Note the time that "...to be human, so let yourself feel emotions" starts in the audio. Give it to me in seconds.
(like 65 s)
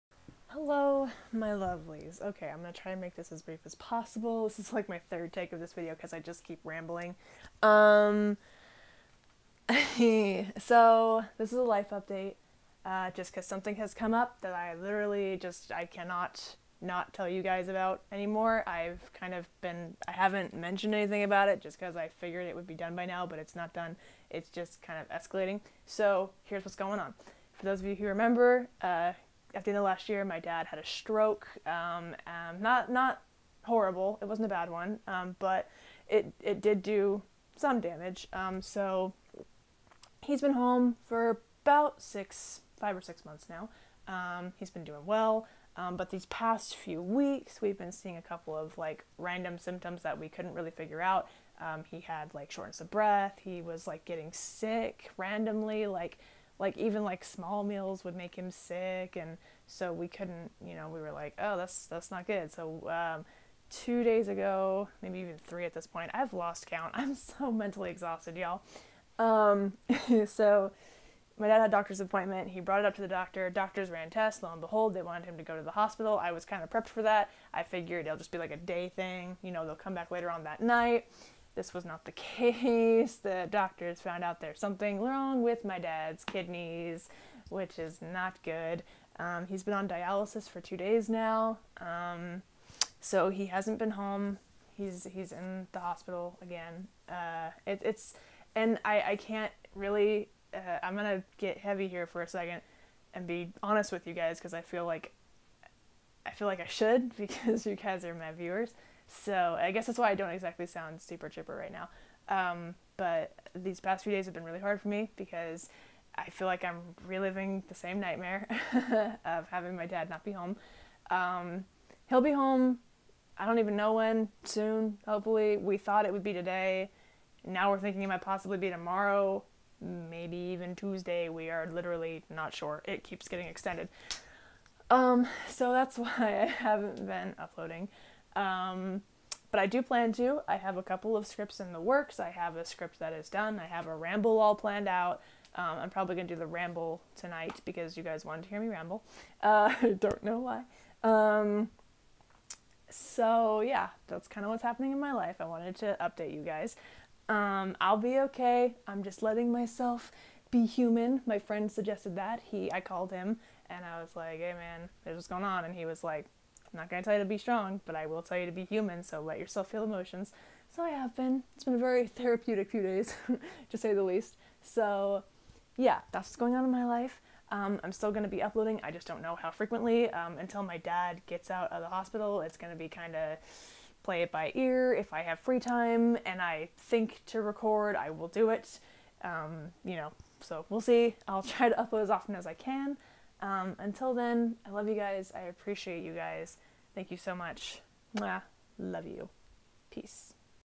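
168 s.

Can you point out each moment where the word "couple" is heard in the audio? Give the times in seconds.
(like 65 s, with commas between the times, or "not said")
48 s, 140 s.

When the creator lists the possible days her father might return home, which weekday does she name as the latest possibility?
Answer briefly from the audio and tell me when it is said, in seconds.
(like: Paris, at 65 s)
Tuesday, at 130 s.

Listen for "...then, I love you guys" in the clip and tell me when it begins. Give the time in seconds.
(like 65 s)
194 s.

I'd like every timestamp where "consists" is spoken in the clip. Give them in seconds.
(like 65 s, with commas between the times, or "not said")
not said.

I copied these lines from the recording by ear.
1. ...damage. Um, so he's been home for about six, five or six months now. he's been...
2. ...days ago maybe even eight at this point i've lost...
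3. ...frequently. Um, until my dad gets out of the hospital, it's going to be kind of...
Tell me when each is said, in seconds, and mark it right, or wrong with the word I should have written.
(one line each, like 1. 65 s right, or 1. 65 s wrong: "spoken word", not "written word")
1. 37 s right
2. 64 s wrong: "three", not "eight"
3. 179 s right.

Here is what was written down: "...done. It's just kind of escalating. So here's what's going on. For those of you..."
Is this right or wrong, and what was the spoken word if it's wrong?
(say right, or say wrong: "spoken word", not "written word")
right.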